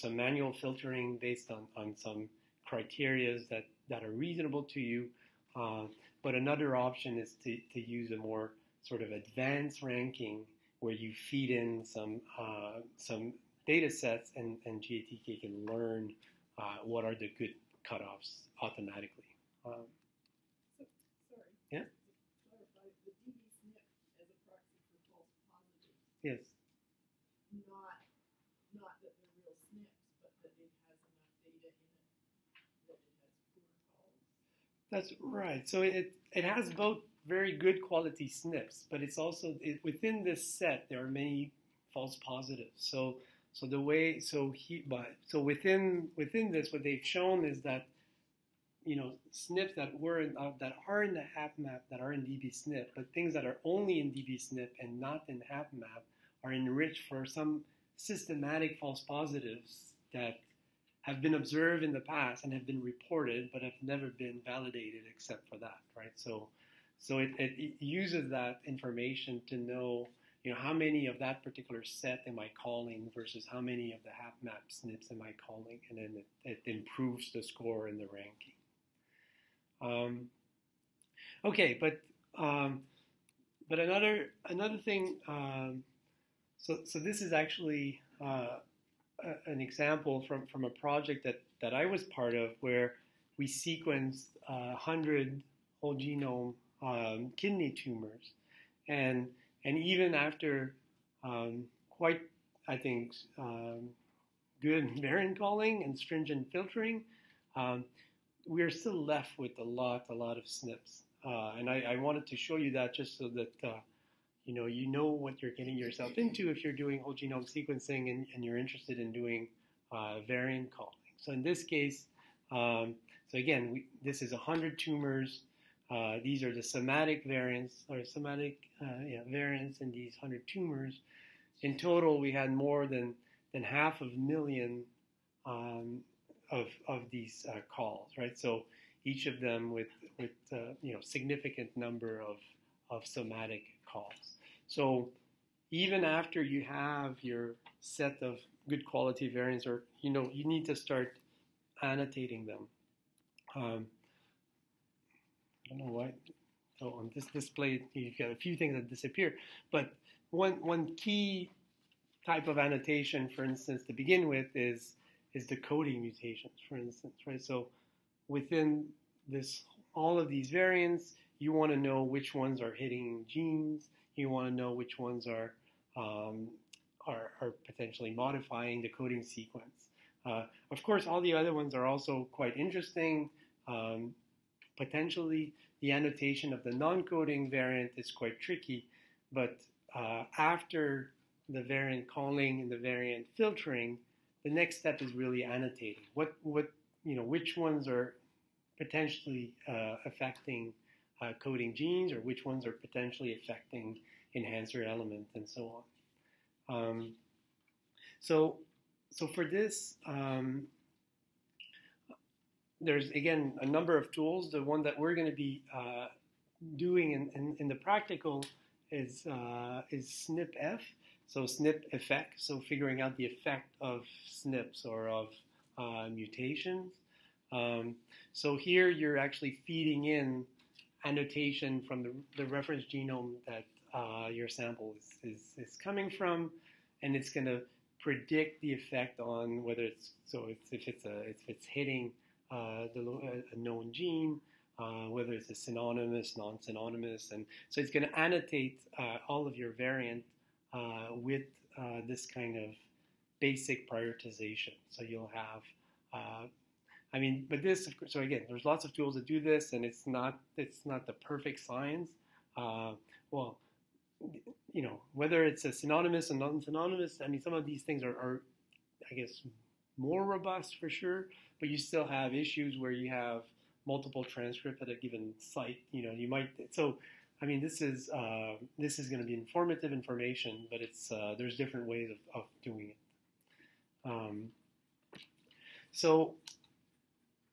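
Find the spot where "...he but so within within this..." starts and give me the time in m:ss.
0:44.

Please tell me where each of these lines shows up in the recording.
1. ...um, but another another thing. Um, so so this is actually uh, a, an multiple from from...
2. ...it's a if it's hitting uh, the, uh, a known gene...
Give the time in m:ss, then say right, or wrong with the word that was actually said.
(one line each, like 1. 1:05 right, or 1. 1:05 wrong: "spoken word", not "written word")
1. 1:22 wrong: "example", not "multiple"
2. 4:00 right.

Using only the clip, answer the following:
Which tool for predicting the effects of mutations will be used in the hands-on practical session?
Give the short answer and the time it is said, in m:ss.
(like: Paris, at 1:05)
SnpEff, at 3:40.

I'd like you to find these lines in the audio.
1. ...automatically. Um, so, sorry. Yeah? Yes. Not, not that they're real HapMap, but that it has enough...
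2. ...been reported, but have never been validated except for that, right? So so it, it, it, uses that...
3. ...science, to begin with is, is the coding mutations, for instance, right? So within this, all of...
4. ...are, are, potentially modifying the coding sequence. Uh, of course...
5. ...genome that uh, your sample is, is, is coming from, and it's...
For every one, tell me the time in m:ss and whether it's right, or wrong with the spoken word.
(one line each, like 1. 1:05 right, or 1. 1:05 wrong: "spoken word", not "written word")
1. 0:18 wrong: "SNPs", not "HapMap"
2. 1:02 right
3. 2:43 wrong: "instance", not "science"
4. 2:57 right
5. 3:52 right.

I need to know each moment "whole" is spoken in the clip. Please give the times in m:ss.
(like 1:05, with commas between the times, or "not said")
1:35, 1:57.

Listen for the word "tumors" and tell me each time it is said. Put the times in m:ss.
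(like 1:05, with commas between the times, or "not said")
1:37, 2:04, 2:10.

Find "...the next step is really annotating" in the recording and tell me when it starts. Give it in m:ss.
3:14.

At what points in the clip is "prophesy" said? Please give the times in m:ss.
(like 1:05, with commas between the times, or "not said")
not said.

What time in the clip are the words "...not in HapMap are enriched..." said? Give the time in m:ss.
0:54.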